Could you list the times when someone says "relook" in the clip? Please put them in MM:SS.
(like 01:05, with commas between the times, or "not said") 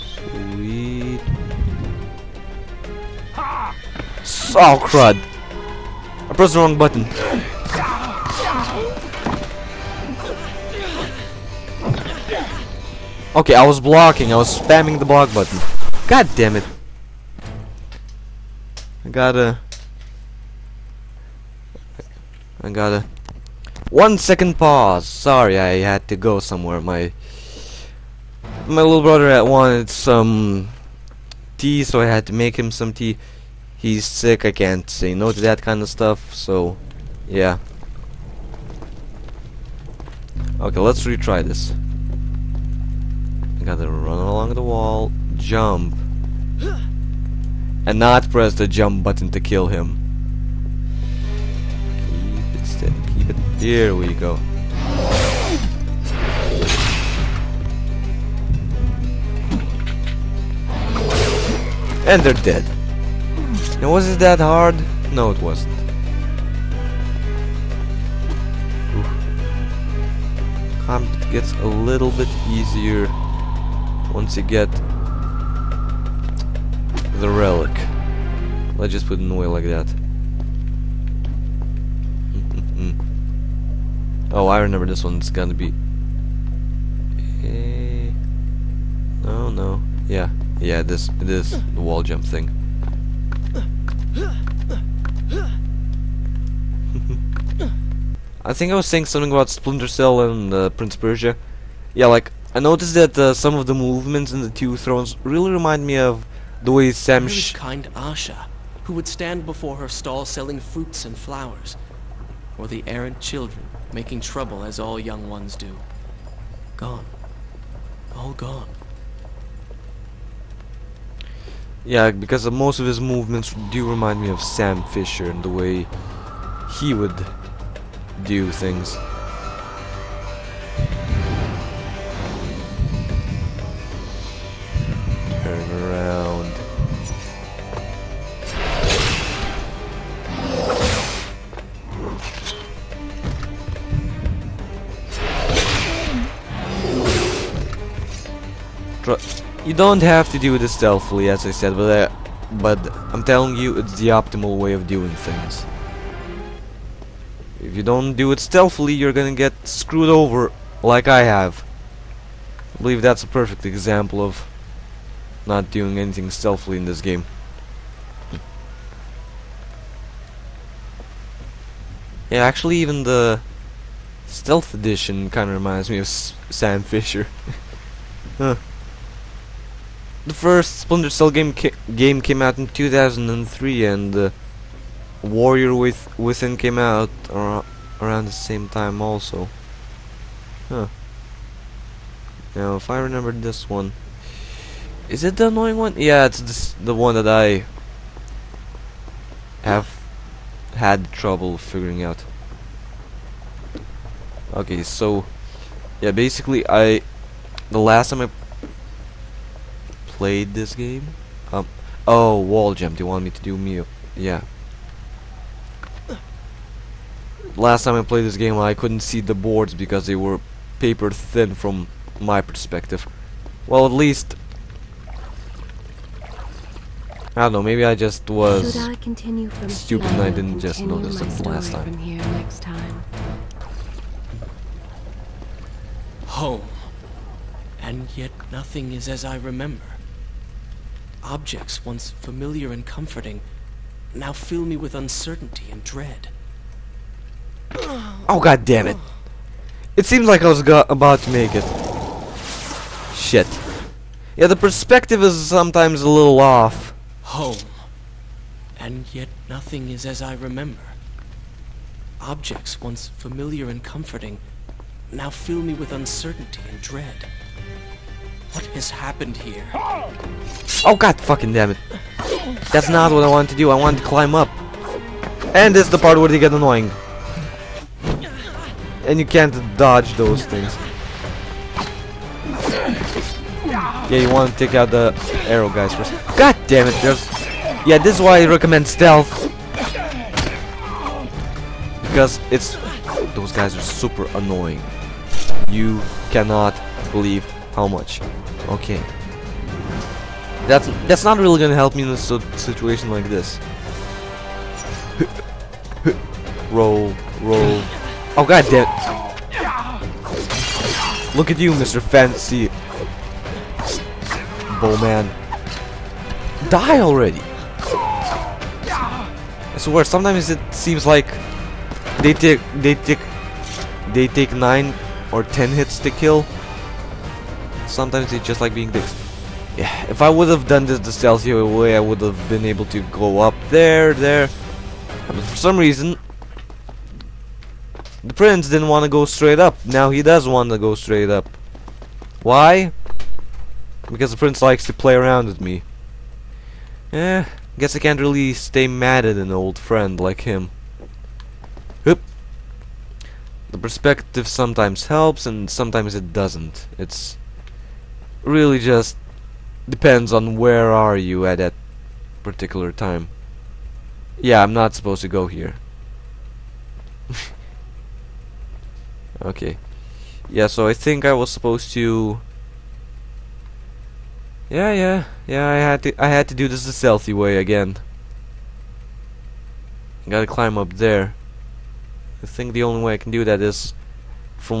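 not said.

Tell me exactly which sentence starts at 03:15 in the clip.
Yeah, it's this, the one that I have had trouble figuring out.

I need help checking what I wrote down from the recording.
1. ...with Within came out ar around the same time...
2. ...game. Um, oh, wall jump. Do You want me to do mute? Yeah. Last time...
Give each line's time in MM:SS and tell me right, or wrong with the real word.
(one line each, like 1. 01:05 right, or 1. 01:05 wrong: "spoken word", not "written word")
1. 03:05 right
2. 03:30 right.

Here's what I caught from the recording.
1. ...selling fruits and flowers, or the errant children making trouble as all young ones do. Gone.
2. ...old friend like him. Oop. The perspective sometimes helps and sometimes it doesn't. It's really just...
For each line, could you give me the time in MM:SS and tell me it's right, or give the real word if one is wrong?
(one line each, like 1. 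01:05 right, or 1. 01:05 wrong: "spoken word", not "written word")
1. 01:50 right
2. 05:49 right.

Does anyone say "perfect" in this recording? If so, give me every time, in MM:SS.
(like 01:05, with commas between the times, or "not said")
02:43.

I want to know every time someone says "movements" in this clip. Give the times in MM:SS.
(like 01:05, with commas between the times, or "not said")
01:43, 02:03.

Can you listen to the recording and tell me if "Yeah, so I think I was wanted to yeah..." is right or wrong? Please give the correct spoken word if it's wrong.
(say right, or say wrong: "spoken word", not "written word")
wrong: "supposed", not "wanted".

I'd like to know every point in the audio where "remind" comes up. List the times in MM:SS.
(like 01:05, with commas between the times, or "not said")
01:45, 02:03, 02:55.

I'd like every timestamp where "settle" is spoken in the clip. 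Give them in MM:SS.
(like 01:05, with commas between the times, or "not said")
not said.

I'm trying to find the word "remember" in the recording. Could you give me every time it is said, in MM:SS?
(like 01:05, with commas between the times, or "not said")
01:24, 03:13, 03:59, 04:20.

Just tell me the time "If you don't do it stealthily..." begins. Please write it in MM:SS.
02:37.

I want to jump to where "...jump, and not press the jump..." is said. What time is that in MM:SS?
00:45.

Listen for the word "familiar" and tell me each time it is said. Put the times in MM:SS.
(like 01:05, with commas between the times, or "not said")
04:02, 04:23.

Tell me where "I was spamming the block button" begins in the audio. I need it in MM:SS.
00:14.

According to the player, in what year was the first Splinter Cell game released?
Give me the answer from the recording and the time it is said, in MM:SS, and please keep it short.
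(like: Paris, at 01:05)
2003, at 03:02.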